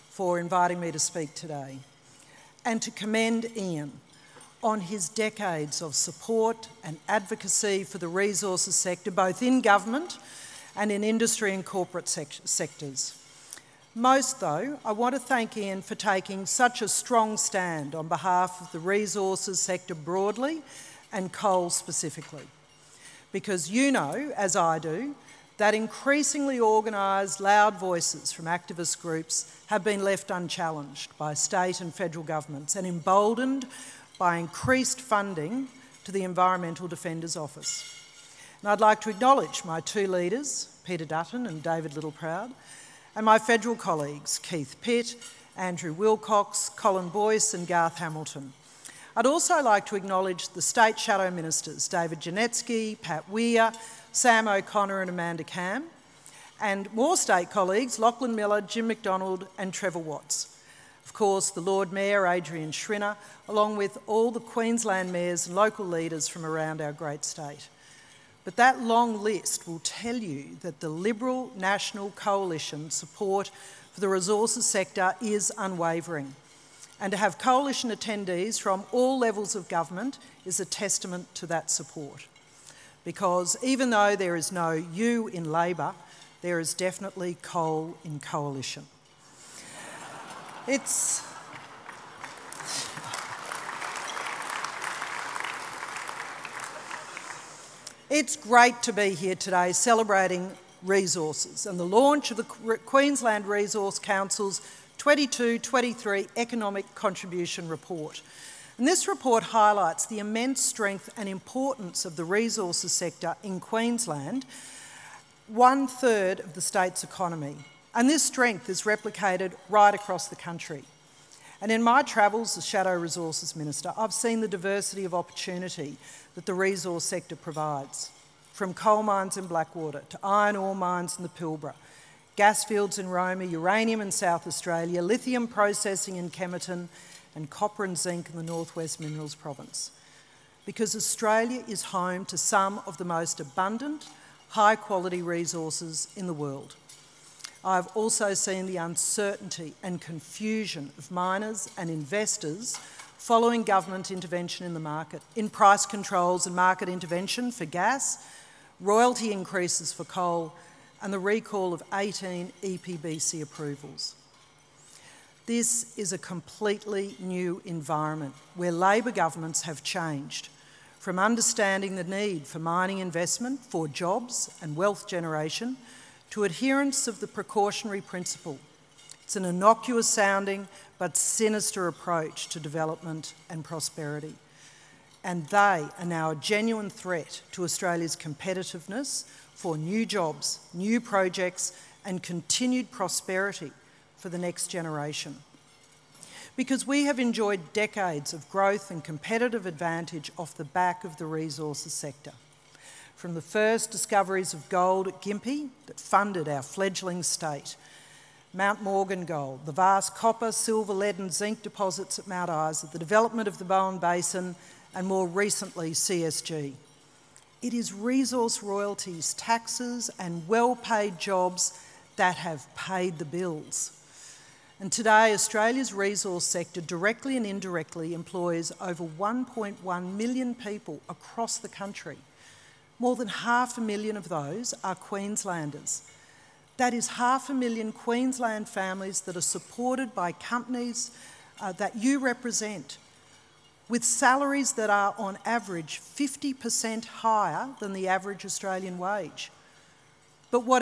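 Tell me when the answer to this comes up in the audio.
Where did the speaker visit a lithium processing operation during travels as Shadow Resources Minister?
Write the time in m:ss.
2:16.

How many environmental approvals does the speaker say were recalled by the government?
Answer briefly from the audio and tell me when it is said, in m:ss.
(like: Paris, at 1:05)
18, at 2:41.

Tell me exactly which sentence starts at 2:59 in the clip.
It's an innocuous sounding but sinister approach to development and prosperity.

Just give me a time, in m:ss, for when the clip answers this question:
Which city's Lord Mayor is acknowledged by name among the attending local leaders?
1:02.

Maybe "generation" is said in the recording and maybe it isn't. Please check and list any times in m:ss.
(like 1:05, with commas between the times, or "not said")
2:55, 3:14.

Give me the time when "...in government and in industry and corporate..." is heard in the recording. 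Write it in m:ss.
0:09.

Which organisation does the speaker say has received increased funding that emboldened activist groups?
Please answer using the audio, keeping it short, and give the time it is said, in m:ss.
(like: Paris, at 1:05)
Environmental Defender's Office, at 0:36.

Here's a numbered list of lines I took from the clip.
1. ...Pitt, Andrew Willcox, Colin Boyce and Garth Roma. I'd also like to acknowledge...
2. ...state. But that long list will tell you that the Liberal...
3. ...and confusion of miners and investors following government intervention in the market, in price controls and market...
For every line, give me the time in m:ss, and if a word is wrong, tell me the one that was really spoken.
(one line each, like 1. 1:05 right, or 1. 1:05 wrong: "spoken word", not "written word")
1. 0:44 wrong: "Hamilton", not "Roma"
2. 1:07 right
3. 2:29 right.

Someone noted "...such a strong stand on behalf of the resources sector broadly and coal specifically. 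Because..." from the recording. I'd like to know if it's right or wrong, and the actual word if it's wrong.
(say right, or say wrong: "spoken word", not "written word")
right.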